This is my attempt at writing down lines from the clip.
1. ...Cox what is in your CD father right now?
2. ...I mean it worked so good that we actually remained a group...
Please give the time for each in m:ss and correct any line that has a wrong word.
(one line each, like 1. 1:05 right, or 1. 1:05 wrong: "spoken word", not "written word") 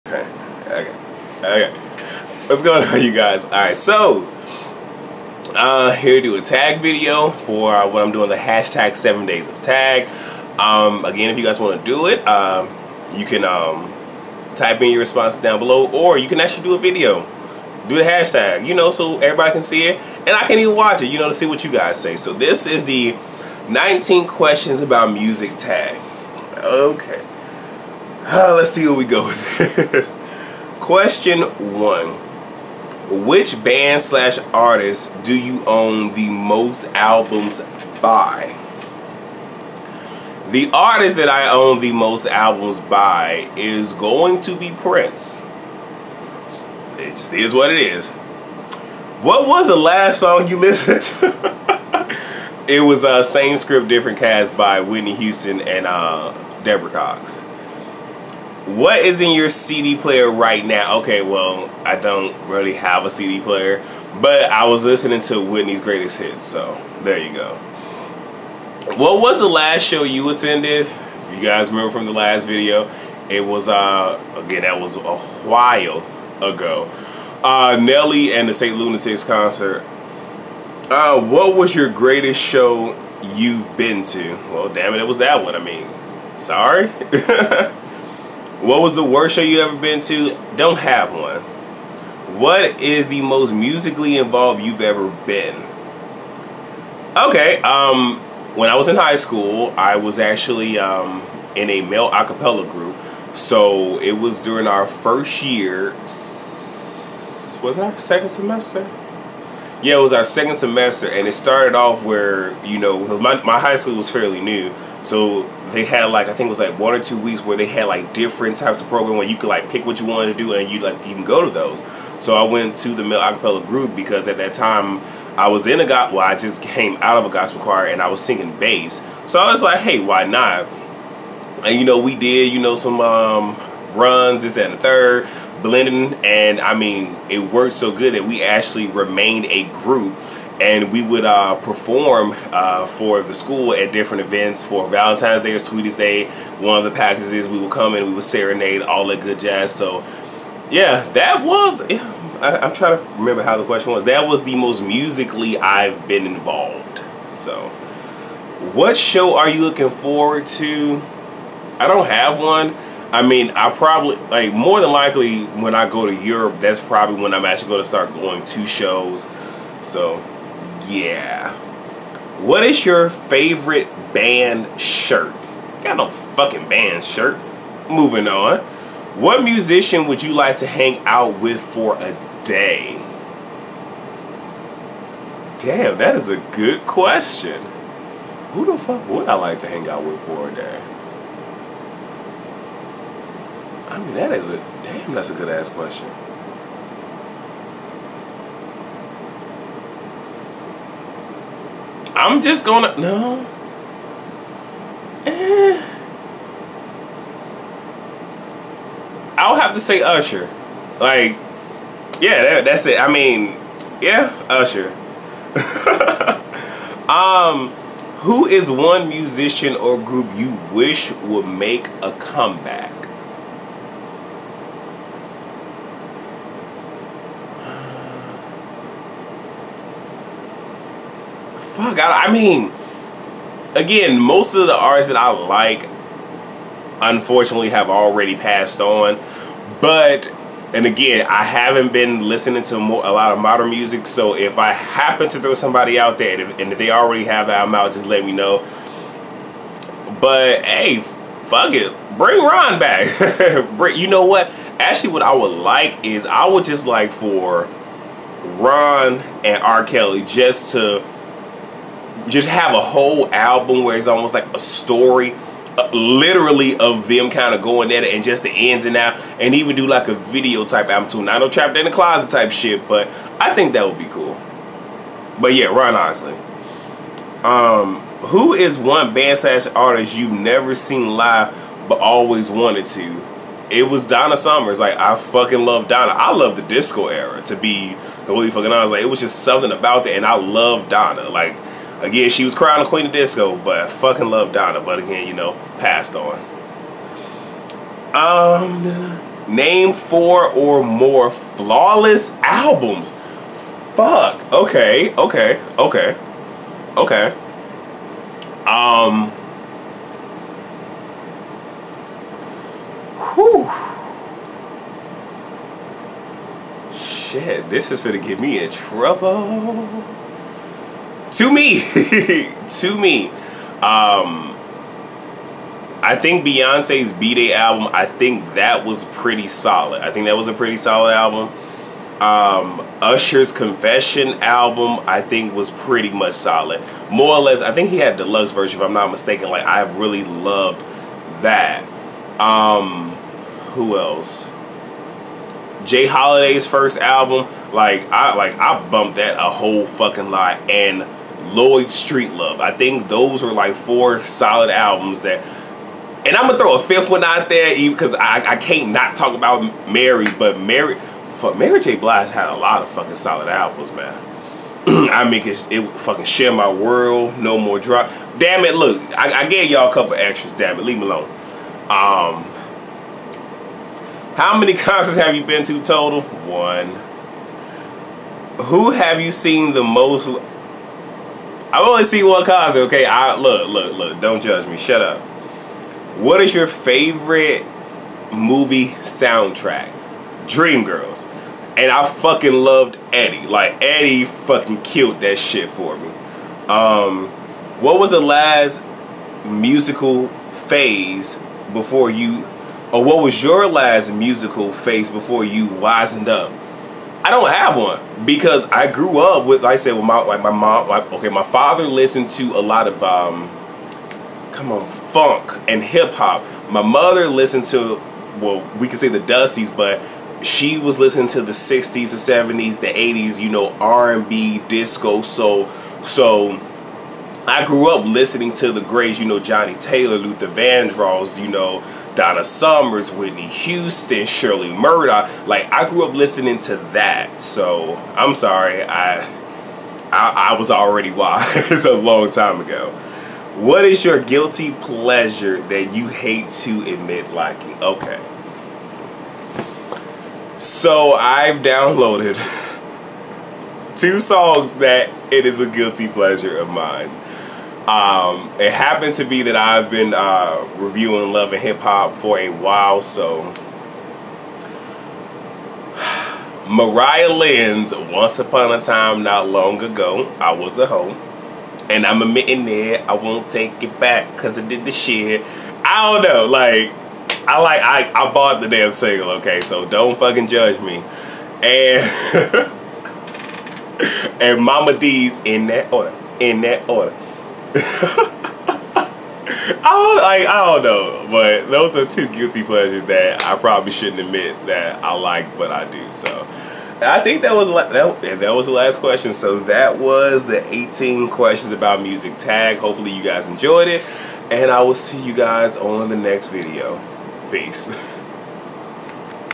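1. 0:56 wrong: "player", not "father"
2. 2:16 right.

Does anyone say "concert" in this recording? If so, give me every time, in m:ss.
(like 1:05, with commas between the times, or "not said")
1:19, 6:14.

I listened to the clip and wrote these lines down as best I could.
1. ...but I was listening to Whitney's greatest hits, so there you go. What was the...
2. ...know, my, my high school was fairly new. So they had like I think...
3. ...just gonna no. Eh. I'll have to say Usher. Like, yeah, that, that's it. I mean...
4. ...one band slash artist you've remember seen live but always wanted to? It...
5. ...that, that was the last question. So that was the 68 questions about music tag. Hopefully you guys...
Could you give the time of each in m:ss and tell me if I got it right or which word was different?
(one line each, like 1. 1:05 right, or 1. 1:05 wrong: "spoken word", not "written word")
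1. 1:04 right
2. 1:52 right
3. 3:22 right
4. 4:38 wrong: "never", not "remember"
5. 8:17 wrong: "18", not "68".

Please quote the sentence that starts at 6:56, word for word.
My mother listened to, well, we could say the Dusties, but she was listening to the '60s, the '70s, the '80s.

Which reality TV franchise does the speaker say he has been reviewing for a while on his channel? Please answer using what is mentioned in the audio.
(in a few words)
Love and Hip Hop.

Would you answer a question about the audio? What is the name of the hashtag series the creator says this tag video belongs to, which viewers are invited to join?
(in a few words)
Seven days of tag.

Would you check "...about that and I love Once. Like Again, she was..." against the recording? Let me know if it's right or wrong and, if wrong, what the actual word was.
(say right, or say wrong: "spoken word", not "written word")
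wrong: "Donna", not "Once".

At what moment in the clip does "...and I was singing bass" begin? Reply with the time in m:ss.
2:07.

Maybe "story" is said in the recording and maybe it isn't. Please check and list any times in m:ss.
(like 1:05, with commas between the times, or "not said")
4:24.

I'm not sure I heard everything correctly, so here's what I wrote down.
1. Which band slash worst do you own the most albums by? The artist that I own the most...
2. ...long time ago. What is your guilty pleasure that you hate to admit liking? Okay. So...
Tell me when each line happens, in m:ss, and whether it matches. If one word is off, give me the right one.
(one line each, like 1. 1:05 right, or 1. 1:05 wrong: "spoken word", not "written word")
1. 0:33 wrong: "artist", not "worst"
2. 7:21 right.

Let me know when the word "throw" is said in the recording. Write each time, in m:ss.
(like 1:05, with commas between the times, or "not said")
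4:05, 5:56.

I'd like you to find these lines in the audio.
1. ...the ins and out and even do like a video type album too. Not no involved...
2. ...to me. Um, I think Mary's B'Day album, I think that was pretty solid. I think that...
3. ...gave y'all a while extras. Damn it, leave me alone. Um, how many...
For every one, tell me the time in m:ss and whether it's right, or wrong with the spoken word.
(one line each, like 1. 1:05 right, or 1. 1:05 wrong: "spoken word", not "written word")
1. 4:28 wrong: "trapped", not "involved"
2. 5:22 wrong: "Beyonce", not "Mary"
3. 6:09 wrong: "couple", not "while".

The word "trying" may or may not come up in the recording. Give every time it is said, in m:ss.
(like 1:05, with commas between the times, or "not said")
2:32.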